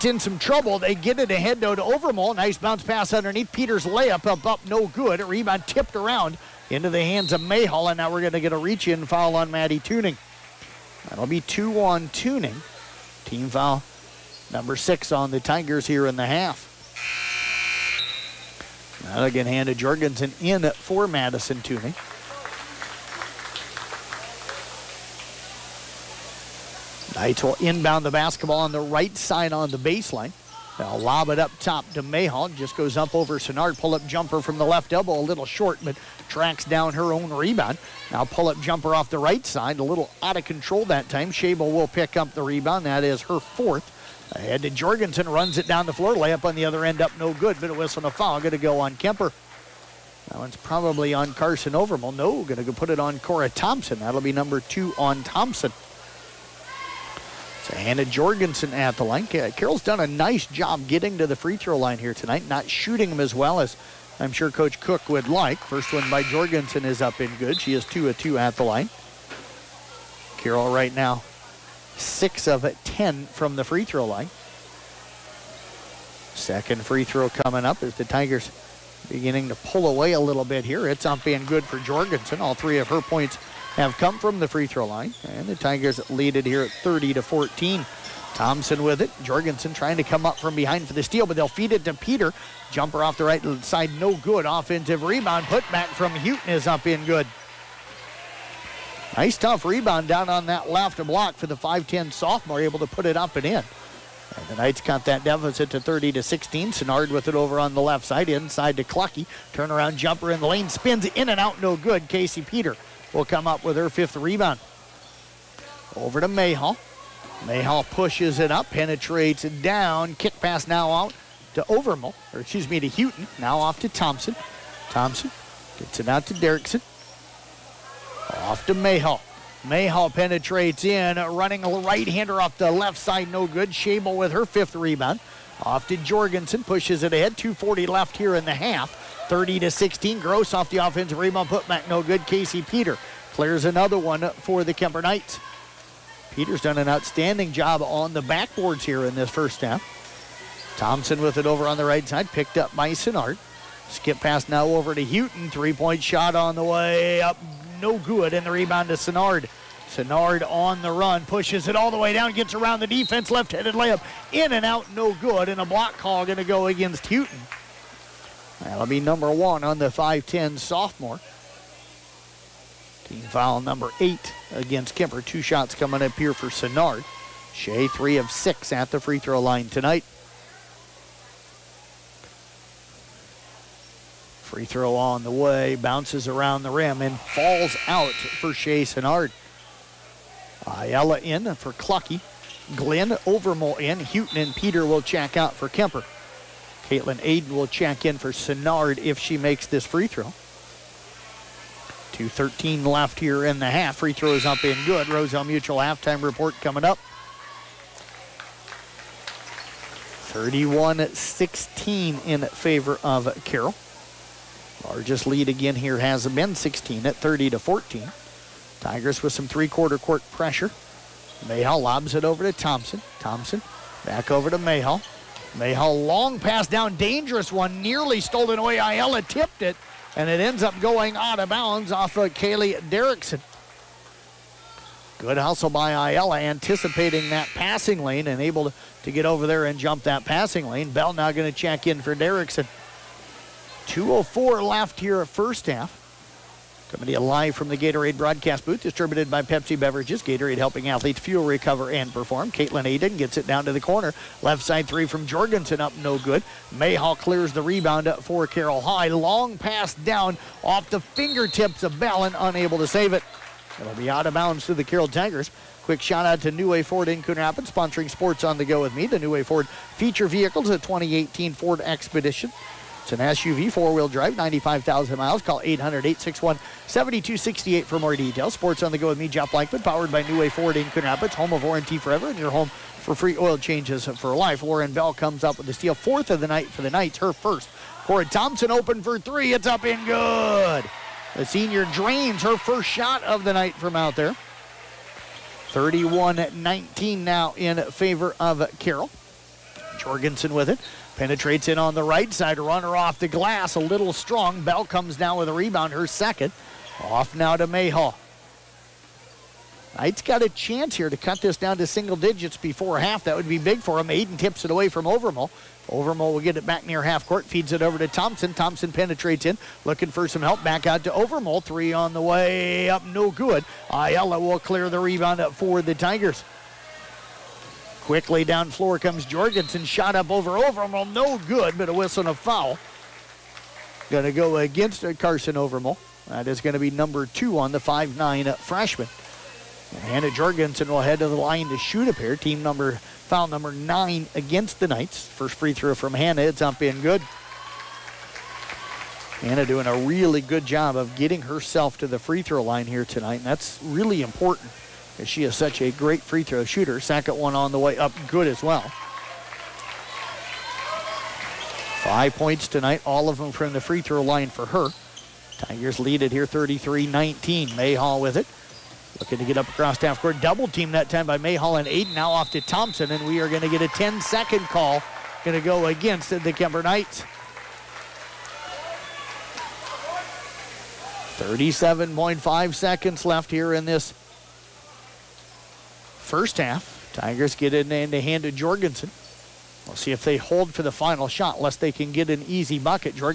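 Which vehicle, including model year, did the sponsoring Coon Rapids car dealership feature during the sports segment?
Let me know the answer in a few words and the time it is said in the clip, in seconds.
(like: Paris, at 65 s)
2018 Ford Expedition, at 270 s.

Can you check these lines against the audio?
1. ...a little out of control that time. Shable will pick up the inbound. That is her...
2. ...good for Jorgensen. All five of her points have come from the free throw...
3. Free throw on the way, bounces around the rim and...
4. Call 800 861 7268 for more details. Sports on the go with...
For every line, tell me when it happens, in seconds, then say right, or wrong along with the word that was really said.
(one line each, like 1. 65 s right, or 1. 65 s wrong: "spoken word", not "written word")
1. 39 s wrong: "rebound", not "inbound"
2. 81 s wrong: "three", not "five"
3. 184 s right
4. 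275 s right.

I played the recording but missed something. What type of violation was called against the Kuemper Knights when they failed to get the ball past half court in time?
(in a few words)
10 second call.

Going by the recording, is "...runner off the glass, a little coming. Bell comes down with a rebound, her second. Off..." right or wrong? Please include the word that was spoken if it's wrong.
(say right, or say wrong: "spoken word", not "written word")
wrong: "strong", not "coming".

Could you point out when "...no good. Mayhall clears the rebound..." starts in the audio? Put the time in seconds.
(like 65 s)
256 s.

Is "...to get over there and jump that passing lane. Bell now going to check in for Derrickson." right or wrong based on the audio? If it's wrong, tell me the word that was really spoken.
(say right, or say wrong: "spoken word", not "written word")
right.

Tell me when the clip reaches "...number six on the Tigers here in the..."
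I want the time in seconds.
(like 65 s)
14 s.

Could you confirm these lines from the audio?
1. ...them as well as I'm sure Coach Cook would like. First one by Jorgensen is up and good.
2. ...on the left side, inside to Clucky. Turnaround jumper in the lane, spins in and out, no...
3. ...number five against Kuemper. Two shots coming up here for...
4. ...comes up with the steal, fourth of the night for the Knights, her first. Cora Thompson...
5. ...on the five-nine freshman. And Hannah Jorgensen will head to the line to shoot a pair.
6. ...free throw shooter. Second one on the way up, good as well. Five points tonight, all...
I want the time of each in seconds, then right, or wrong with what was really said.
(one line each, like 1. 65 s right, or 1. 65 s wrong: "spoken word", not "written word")
1. 63 s right
2. 107 s right
3. 173 s wrong: "eight", not "five"
4. 285 s right
5. 337 s right
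6. 356 s right.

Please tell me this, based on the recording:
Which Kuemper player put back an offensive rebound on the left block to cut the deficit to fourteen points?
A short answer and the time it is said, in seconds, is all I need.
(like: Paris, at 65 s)
Hutton, at 95 s.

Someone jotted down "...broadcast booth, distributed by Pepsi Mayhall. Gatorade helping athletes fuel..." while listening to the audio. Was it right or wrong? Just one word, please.
wrong.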